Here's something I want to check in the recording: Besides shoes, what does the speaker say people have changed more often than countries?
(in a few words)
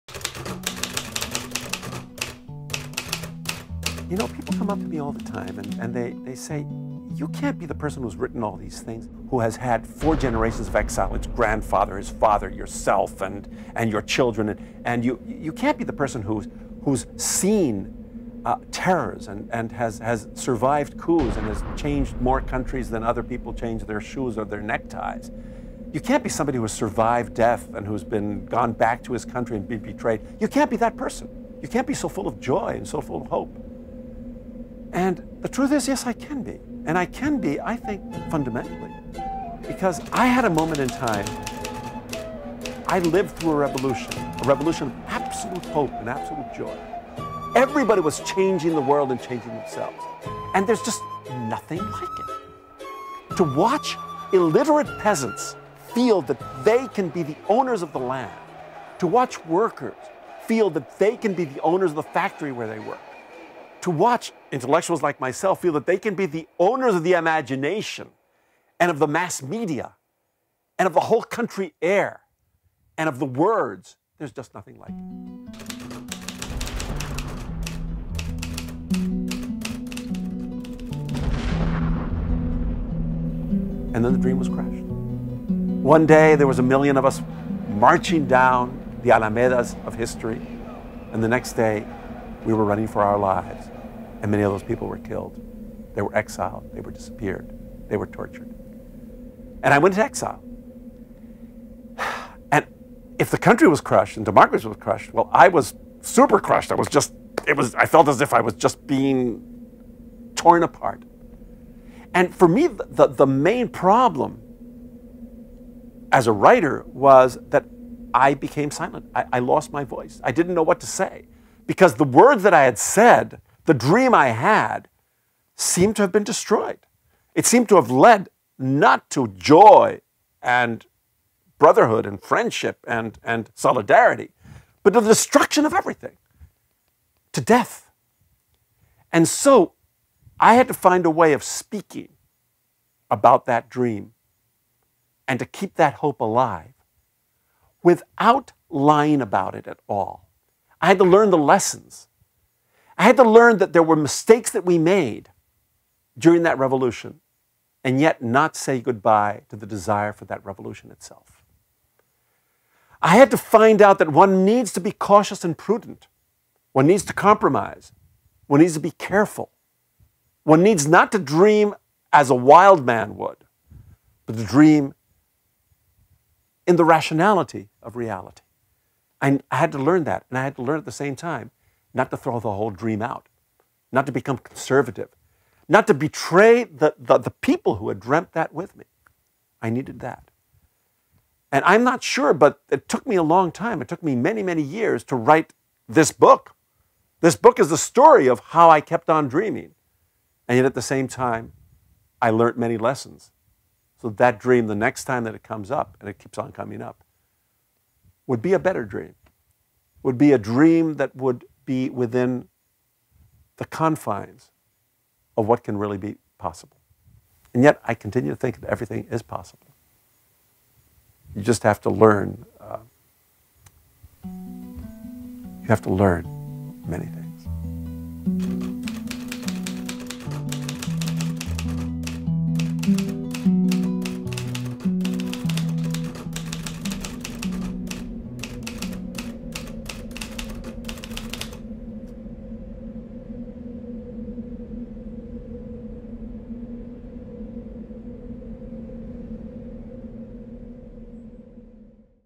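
neckties.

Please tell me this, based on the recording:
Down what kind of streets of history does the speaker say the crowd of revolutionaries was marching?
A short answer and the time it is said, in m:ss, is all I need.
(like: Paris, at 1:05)
alamedas, at 1:29.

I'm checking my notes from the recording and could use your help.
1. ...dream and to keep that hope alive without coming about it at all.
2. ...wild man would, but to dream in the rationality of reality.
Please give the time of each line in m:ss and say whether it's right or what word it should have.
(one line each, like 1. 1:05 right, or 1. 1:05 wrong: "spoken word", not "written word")
1. 2:23 wrong: "lying", not "coming"
2. 2:52 right.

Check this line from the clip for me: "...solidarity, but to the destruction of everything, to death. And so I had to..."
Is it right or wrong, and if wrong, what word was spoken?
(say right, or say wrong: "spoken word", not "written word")
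right.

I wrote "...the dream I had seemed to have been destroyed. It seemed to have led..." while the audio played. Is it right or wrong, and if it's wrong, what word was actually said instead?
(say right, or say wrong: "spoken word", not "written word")
right.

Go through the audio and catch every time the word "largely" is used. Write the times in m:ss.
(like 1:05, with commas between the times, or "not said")
not said.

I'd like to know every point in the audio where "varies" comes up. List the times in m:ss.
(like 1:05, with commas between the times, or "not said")
not said.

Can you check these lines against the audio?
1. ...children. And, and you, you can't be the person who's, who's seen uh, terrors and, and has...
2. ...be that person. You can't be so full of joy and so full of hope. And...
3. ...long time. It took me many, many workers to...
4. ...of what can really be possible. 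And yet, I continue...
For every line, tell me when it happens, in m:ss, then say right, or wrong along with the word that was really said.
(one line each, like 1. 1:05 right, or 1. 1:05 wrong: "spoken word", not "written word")
1. 0:14 right
2. 0:30 right
3. 3:13 wrong: "years", not "workers"
4. 3:35 right.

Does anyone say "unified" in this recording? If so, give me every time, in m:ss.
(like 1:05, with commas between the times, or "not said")
not said.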